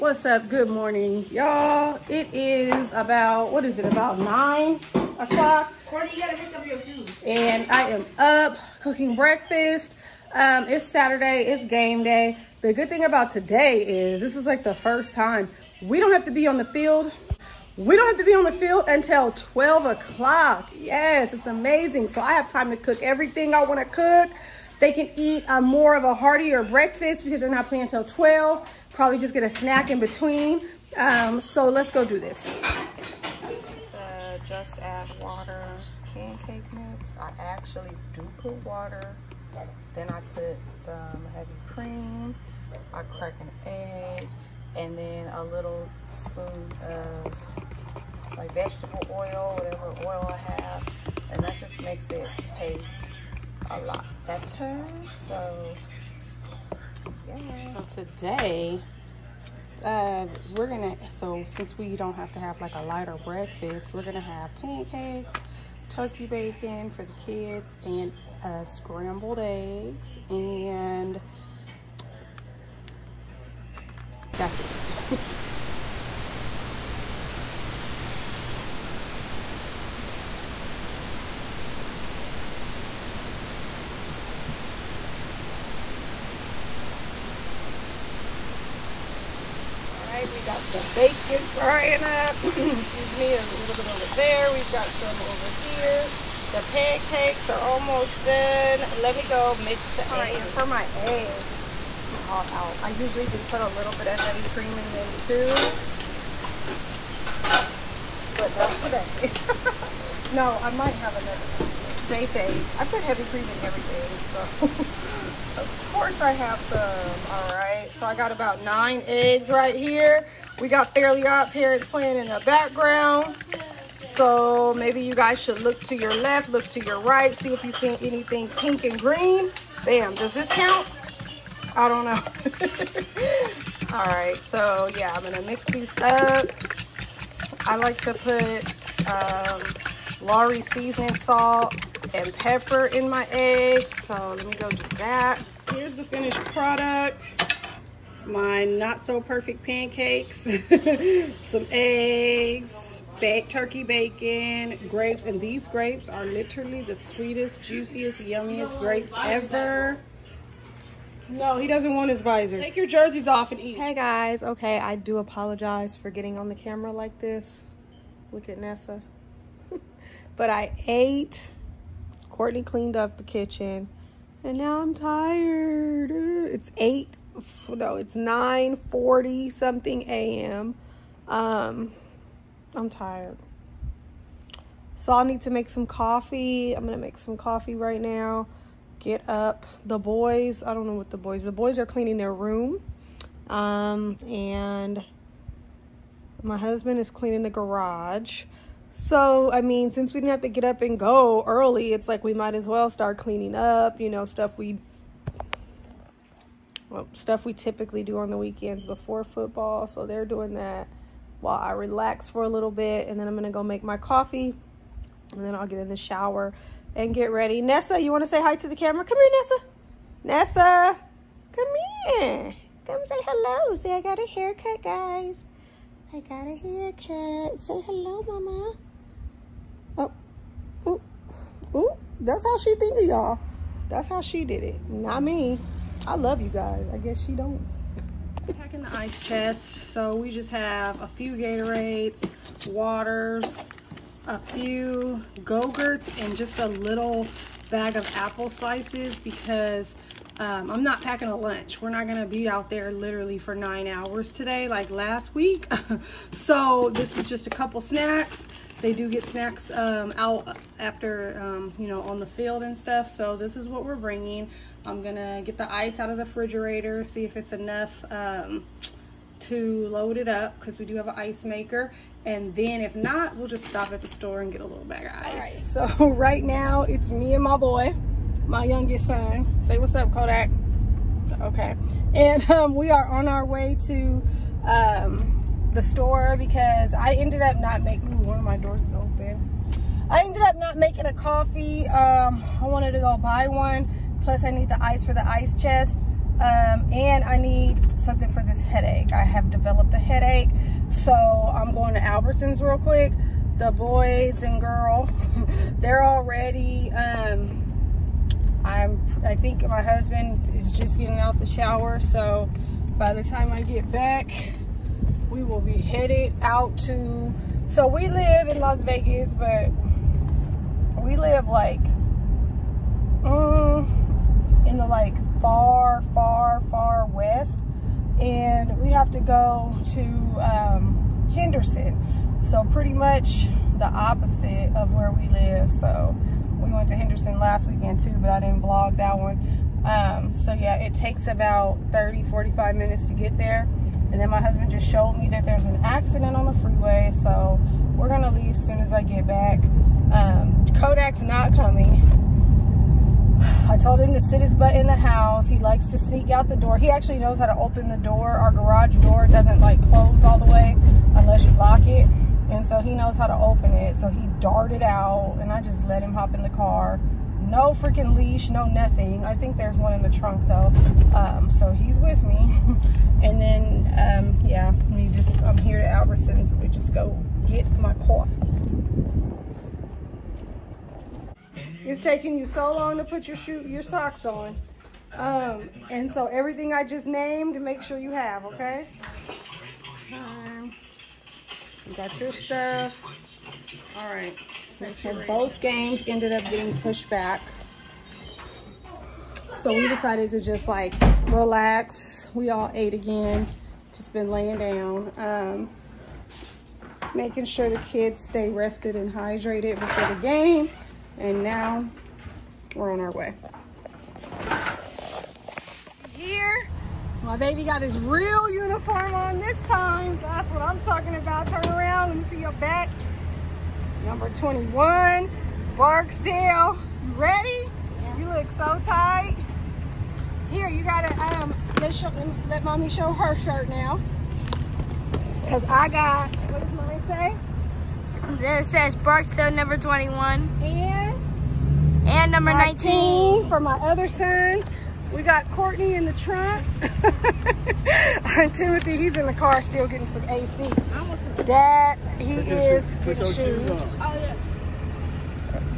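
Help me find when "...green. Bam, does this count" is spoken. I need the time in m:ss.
2:08.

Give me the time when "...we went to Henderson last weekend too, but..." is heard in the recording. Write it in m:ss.
5:36.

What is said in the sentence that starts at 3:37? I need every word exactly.
Nessa, you want to say hi to the camera?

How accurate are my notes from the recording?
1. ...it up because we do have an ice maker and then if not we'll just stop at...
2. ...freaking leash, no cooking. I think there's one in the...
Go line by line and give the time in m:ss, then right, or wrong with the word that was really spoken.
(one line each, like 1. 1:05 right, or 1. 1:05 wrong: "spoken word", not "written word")
1. 4:30 right
2. 6:07 wrong: "nothing", not "cooking".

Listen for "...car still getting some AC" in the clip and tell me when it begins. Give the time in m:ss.
7:29.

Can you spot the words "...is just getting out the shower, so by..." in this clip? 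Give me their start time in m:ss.
5:10.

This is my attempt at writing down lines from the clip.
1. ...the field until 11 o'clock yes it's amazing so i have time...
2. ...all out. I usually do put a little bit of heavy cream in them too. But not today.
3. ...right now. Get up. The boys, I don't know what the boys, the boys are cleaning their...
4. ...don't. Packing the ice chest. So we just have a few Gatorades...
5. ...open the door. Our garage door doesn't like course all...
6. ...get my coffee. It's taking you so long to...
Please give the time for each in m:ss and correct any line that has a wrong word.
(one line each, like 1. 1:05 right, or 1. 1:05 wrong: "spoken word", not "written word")
1. 0:18 wrong: "12", not "11"
2. 1:42 right
3. 3:07 right
4. 3:57 right
5. 5:57 wrong: "close", not "course"
6. 6:17 right.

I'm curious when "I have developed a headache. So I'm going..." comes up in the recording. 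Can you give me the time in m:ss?
4:59.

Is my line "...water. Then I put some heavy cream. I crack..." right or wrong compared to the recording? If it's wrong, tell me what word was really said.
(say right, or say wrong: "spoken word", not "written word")
right.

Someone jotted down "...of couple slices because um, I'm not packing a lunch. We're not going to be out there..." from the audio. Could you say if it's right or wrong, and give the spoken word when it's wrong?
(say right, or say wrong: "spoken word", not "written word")
wrong: "apple", not "couple".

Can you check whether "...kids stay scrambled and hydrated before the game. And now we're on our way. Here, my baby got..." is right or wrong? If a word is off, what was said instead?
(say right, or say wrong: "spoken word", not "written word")
wrong: "rested", not "scrambled".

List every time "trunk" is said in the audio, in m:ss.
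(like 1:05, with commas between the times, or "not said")
6:10, 7:26.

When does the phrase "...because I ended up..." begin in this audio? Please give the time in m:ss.
4:46.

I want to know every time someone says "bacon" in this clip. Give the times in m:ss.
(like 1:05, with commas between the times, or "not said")
1:06, 1:30, 2:33.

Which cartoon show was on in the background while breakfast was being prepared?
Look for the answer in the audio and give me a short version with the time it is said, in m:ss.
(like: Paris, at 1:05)
Fairly Odd Parents, at 2:00.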